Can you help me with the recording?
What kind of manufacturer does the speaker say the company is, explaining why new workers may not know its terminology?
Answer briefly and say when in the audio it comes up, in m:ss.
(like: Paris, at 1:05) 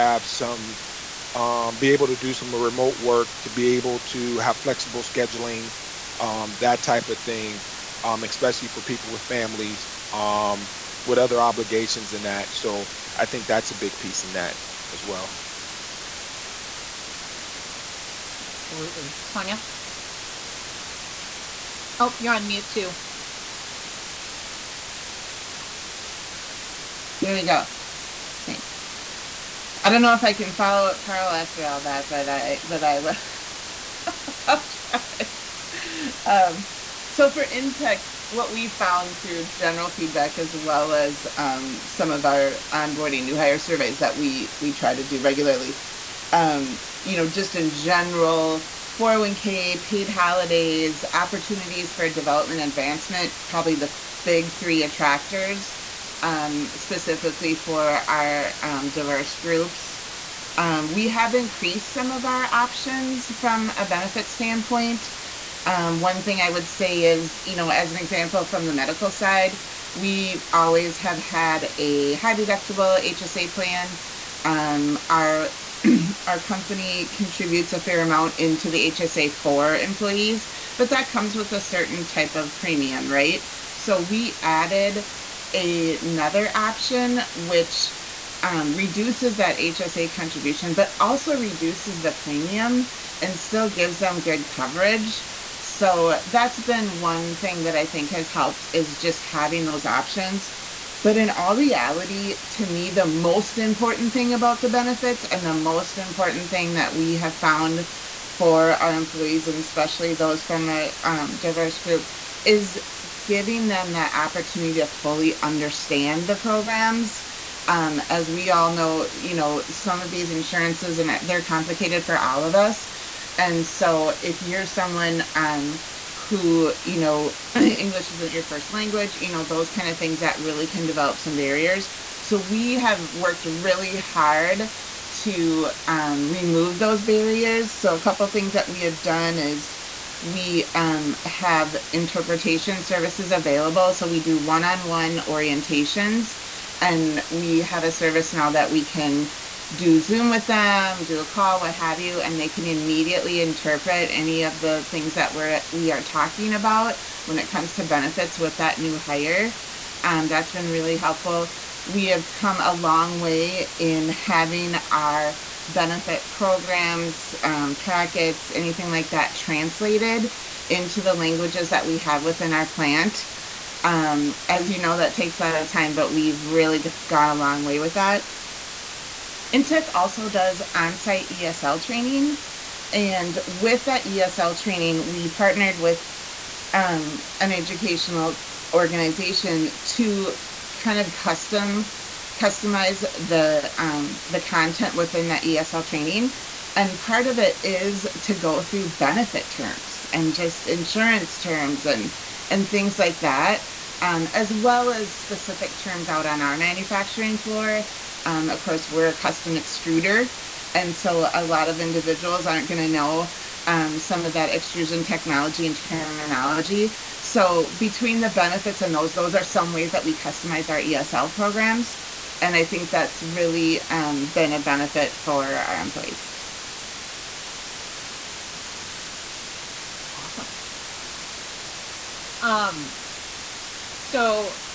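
Custom extruder, at 3:29.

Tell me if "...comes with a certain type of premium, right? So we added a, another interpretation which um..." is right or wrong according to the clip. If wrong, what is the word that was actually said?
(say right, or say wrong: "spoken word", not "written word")
wrong: "option", not "interpretation".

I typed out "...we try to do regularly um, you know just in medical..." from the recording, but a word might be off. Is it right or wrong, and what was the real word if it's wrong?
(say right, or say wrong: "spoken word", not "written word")
wrong: "general", not "medical".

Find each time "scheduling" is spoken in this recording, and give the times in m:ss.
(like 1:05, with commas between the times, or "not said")
0:05.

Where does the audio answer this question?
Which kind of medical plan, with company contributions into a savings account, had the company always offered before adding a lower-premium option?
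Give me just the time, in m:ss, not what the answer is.
1:12.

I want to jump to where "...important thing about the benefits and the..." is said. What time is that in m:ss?
1:43.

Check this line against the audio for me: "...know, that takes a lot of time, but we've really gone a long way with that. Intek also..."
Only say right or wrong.
right.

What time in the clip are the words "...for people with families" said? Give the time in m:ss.
0:08.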